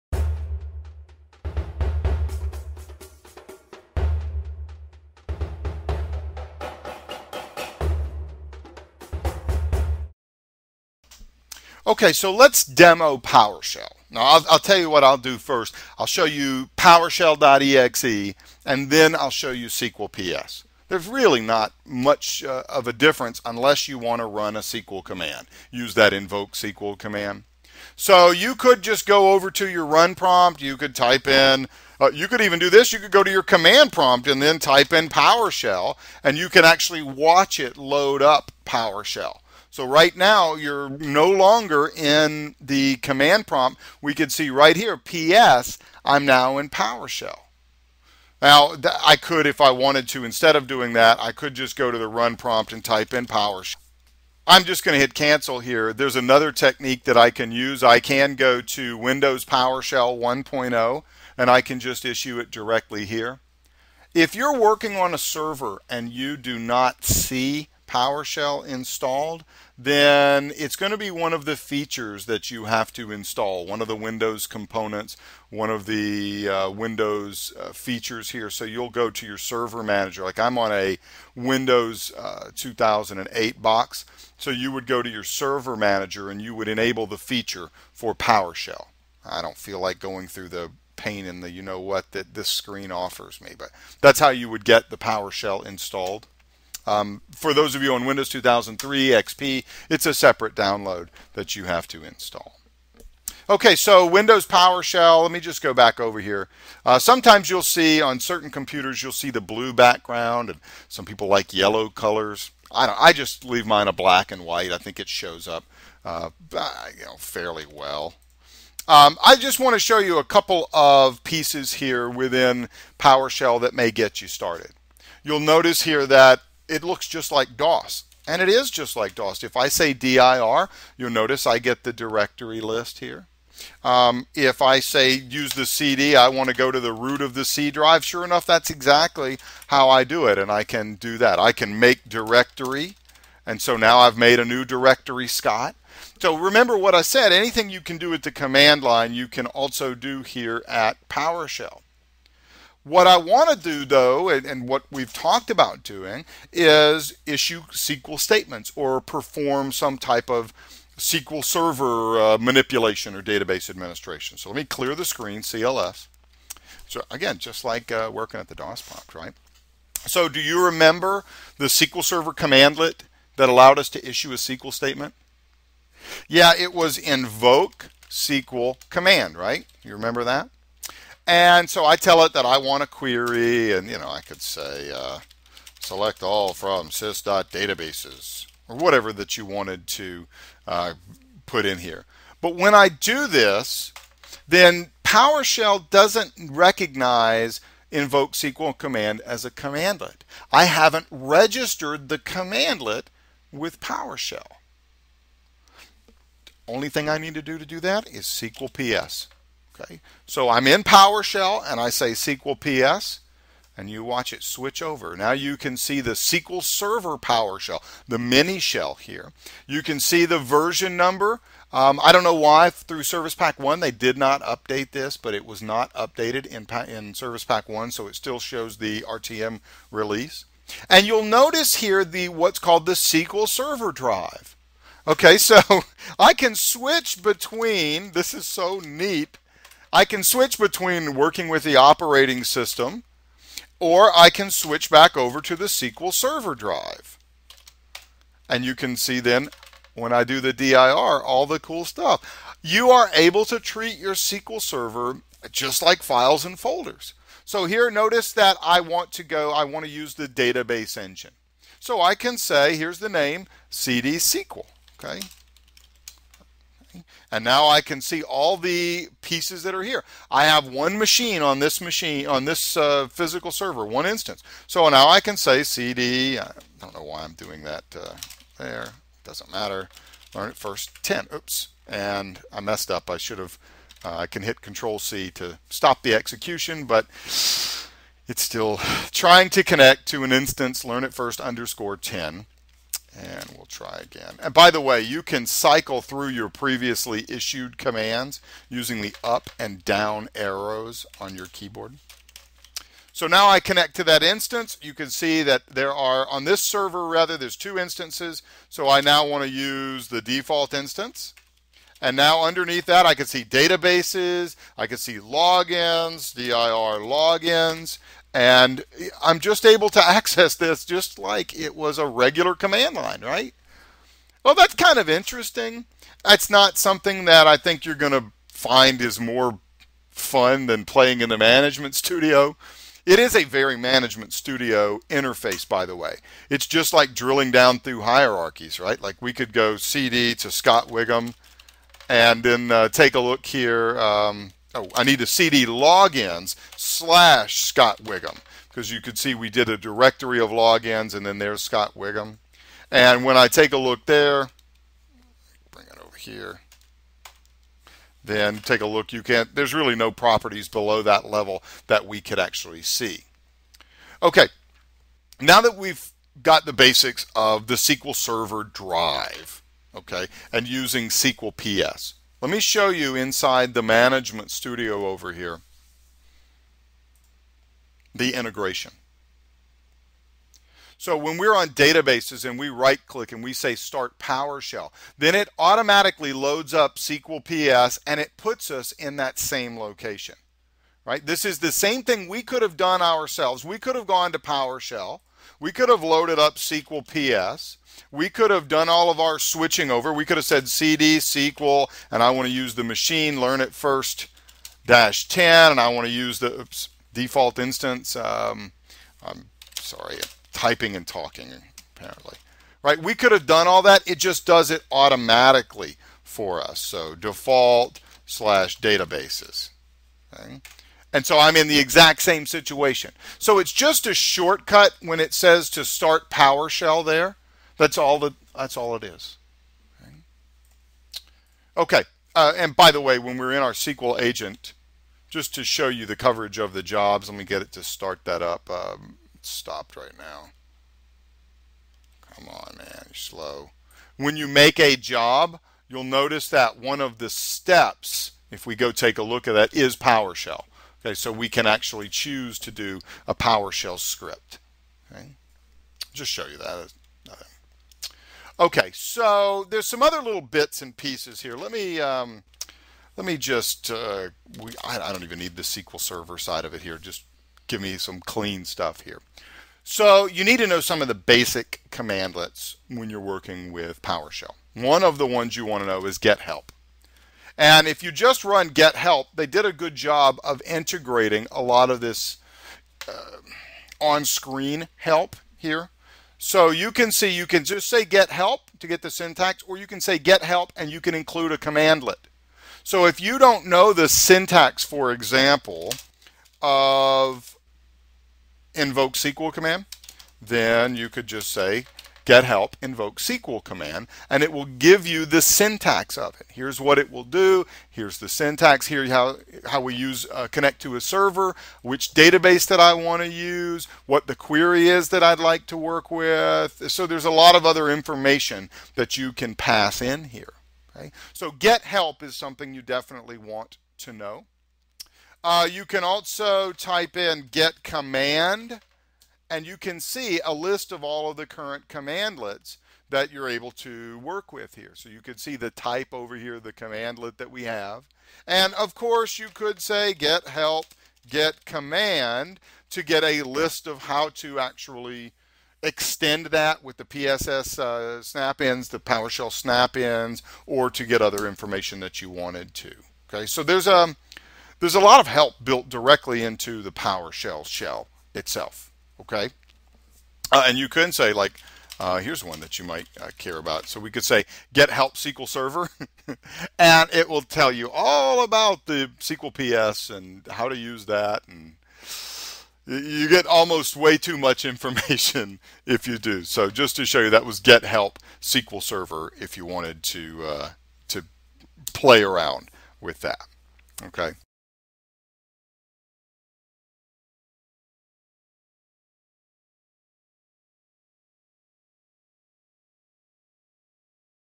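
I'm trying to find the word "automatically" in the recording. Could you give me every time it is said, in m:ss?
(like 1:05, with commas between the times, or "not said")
6:25, 6:54.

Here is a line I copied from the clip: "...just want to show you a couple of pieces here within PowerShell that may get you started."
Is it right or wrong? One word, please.
right.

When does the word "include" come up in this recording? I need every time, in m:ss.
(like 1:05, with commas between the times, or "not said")
8:11.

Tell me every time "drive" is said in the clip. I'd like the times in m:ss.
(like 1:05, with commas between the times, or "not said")
2:17, 3:53, 4:06, 6:08.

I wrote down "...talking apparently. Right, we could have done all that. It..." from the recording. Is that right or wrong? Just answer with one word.
right.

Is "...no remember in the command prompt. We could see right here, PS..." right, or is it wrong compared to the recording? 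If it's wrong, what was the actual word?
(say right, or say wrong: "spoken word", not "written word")
wrong: "longer", not "remember".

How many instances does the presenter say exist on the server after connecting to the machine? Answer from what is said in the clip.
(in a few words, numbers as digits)
2.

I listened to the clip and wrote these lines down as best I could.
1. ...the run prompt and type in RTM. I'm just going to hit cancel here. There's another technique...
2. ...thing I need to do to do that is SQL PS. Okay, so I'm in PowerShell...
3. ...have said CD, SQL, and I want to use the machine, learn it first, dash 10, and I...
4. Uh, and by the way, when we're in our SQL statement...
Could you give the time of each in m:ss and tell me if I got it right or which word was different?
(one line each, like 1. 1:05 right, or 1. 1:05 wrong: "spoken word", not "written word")
1. 0:51 wrong: "PowerShell", not "RTM"
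2. 3:26 right
3. 6:40 right
4. 7:12 wrong: "agent", not "statement".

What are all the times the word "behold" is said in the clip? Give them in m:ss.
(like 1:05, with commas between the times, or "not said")
not said.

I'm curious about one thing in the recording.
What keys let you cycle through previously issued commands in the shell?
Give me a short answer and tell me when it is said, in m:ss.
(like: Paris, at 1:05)
Up and down arrows, at 4:59.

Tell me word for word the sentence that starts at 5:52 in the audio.
And when I take a look there, bring it over here, then take a look.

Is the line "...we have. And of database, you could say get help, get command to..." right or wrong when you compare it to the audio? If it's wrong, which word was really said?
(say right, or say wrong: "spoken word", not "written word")
wrong: "course", not "database".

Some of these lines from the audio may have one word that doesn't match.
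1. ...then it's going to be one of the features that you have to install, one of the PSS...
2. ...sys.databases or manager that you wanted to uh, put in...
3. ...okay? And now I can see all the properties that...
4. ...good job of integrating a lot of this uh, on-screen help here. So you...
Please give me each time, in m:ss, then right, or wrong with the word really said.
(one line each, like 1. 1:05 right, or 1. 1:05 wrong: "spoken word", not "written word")
1. 1:09 wrong: "Windows", not "PSS"
2. 3:06 wrong: "whatever", not "manager"
3. 4:25 wrong: "pieces", not "properties"
4. 7:59 right.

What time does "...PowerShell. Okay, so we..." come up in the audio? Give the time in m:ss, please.
7:29.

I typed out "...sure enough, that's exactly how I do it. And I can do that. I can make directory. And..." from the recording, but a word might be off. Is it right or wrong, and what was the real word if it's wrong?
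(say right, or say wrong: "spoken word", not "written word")
right.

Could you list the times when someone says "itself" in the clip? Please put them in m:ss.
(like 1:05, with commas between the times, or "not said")
9:18.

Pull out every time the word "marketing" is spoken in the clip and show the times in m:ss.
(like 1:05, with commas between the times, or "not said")
not said.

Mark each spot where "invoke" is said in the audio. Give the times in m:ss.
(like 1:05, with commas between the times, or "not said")
0:26, 2:56, 3:17, 8:18, 8:22.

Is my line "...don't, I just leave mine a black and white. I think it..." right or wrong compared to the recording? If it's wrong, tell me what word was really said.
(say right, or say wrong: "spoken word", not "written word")
right.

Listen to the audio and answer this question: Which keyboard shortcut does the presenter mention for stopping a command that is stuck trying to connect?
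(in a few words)
Control C.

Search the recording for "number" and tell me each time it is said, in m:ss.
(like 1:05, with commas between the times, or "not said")
3:40.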